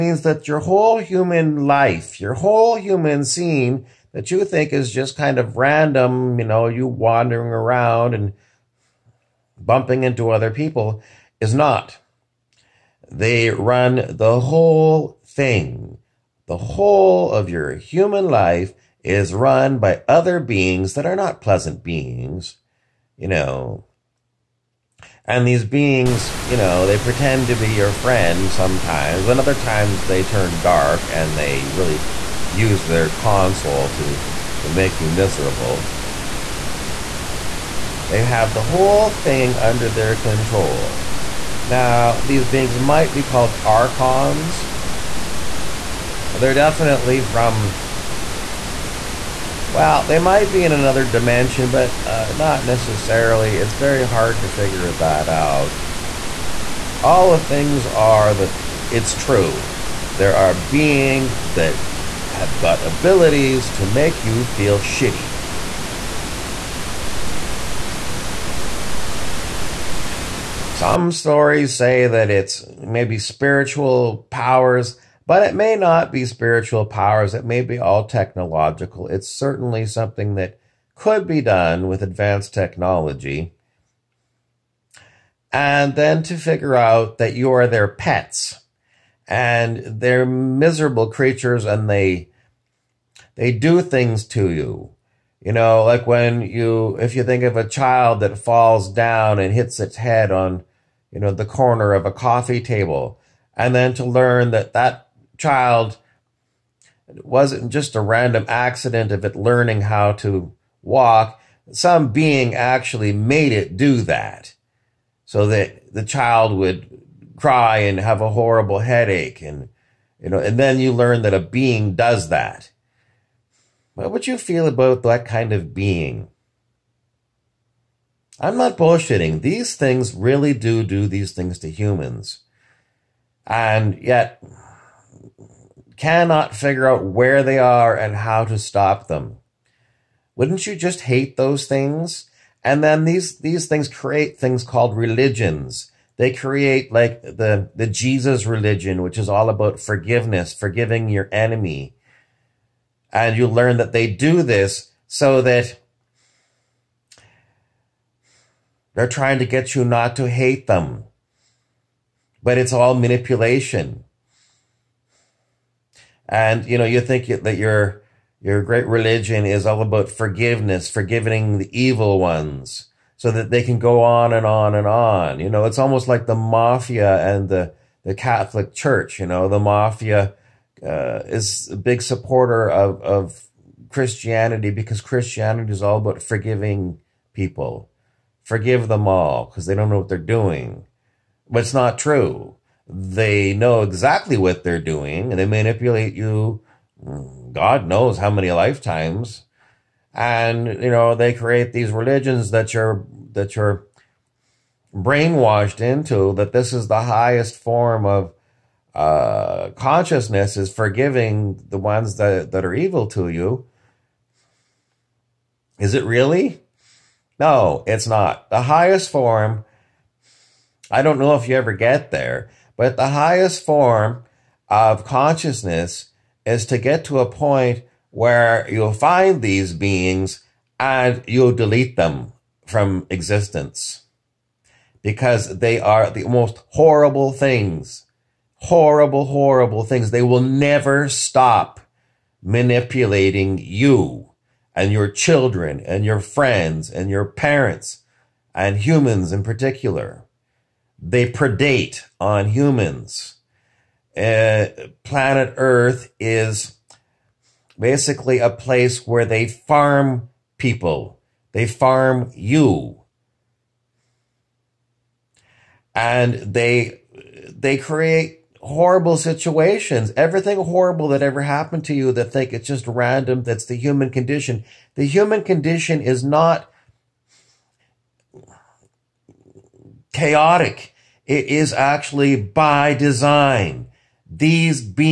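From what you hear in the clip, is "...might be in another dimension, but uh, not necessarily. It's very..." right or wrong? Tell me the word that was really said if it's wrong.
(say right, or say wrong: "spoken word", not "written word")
right.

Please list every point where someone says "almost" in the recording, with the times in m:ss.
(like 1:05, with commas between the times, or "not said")
2:55.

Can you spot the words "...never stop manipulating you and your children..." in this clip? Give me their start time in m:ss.
4:00.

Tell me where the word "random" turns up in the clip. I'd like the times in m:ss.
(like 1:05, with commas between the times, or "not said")
0:05, 1:48, 4:32.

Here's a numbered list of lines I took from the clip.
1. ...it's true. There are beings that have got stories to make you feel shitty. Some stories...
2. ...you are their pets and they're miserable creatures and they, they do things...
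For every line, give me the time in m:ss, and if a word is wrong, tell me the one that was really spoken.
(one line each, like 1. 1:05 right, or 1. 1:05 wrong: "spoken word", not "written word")
1. 0:58 wrong: "abilities", not "stories"
2. 1:27 right.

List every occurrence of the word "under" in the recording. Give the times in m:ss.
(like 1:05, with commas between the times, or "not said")
0:39.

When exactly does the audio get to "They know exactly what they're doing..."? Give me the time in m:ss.
3:12.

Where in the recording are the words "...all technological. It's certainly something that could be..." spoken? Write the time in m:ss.
1:17.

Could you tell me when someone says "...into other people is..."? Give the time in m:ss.
0:10.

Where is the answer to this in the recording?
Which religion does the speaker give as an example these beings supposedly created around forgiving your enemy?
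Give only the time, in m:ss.
2:27.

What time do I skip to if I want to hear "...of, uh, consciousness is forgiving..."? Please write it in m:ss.
3:28.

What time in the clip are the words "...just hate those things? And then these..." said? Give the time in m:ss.
2:20.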